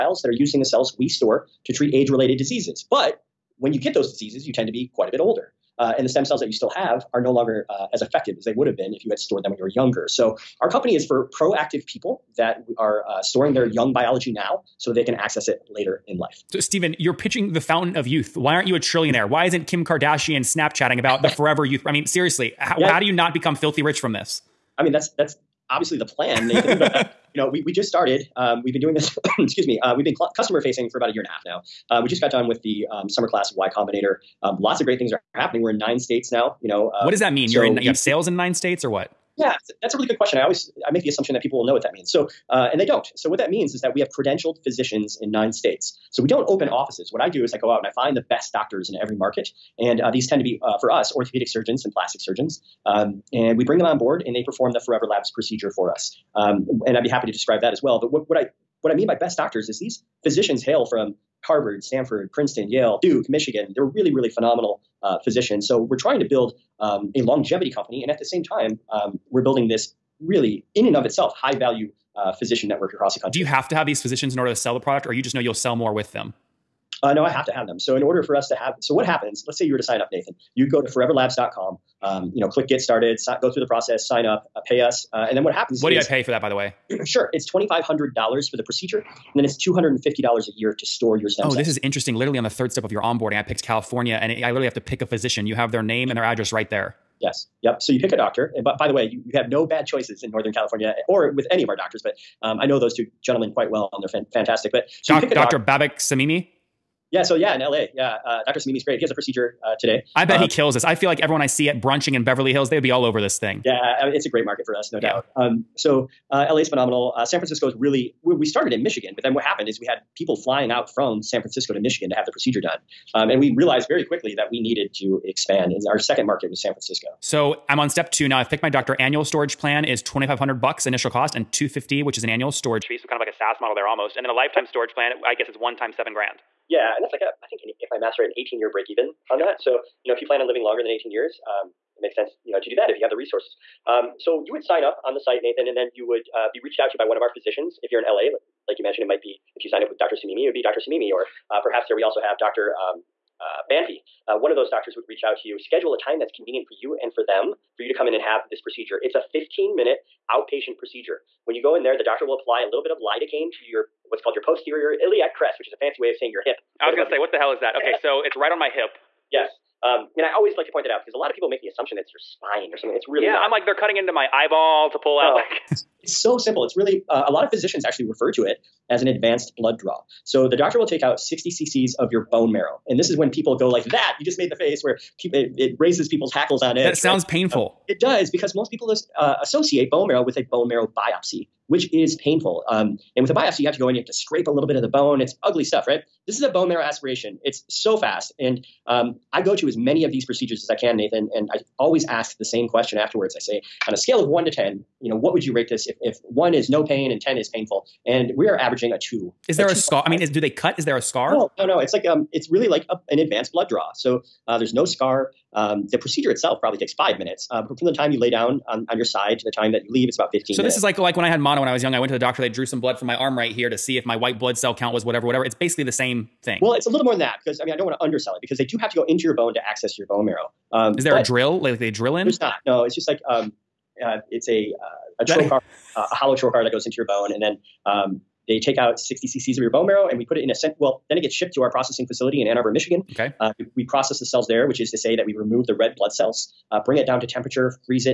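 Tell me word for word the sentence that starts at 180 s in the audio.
So the doctor will take out 60 cc's of your bone marrow.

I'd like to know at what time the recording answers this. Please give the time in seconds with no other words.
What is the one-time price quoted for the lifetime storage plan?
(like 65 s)
135 s.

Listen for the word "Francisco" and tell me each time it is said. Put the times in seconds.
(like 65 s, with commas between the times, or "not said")
117 s, 121 s, 126 s.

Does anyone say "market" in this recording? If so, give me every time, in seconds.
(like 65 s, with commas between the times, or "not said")
49 s, 114 s, 126 s.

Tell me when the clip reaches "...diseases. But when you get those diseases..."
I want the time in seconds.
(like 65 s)
2 s.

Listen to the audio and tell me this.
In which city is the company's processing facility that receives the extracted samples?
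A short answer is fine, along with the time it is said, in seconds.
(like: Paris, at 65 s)
Ann Arbor, Michigan, at 242 s.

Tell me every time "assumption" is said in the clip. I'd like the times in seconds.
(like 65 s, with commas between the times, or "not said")
41 s, 171 s.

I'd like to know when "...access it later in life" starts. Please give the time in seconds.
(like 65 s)
15 s.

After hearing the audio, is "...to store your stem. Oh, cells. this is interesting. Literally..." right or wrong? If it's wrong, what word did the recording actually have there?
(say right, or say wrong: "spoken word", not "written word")
right.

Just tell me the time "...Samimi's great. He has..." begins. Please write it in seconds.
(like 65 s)
108 s.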